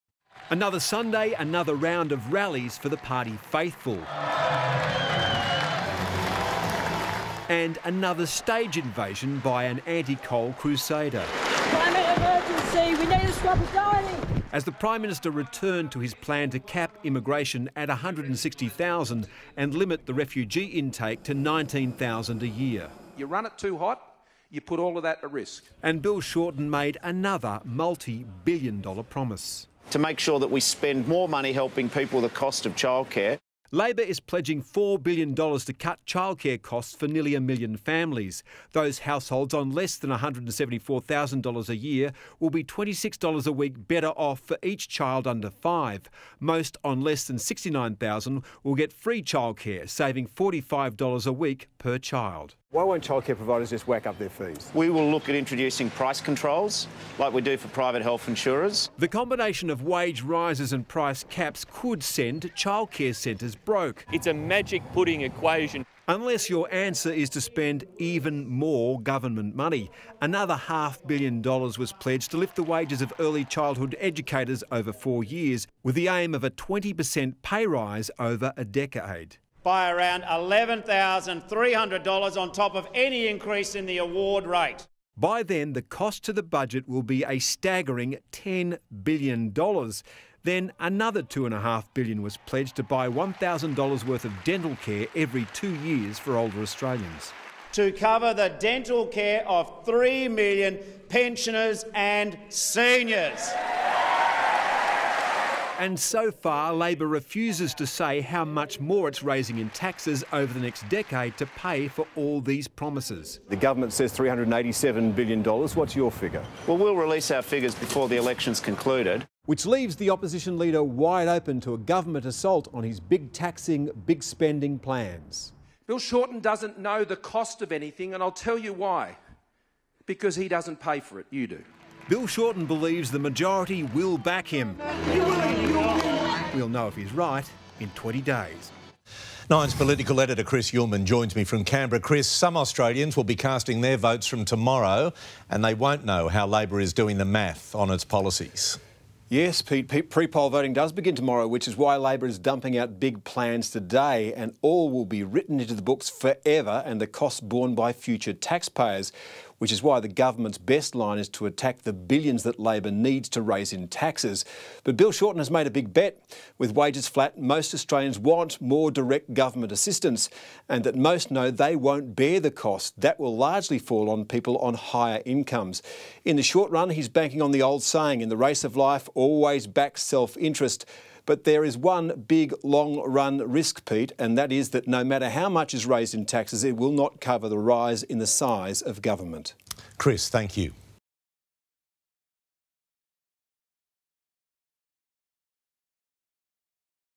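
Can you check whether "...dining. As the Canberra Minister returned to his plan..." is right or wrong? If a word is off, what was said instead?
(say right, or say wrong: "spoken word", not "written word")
wrong: "Prime", not "Canberra".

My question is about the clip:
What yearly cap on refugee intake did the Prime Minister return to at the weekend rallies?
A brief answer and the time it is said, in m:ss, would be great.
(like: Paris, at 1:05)
19,000, at 0:21.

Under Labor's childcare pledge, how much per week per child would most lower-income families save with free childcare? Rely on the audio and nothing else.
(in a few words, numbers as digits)
$45.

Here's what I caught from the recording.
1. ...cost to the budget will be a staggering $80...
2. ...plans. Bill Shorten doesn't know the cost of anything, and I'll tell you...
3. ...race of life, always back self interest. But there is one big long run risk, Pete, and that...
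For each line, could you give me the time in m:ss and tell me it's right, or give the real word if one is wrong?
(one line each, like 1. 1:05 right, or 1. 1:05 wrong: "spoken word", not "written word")
1. 1:25 wrong: "10", not "80"
2. 2:04 right
3. 2:58 right.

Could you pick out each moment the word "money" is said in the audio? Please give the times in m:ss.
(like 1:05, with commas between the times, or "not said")
0:31, 1:09.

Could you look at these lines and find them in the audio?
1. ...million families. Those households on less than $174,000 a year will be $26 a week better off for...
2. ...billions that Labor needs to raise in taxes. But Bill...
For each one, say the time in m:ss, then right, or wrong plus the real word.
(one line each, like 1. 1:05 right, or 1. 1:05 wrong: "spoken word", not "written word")
1. 0:37 right
2. 2:41 right.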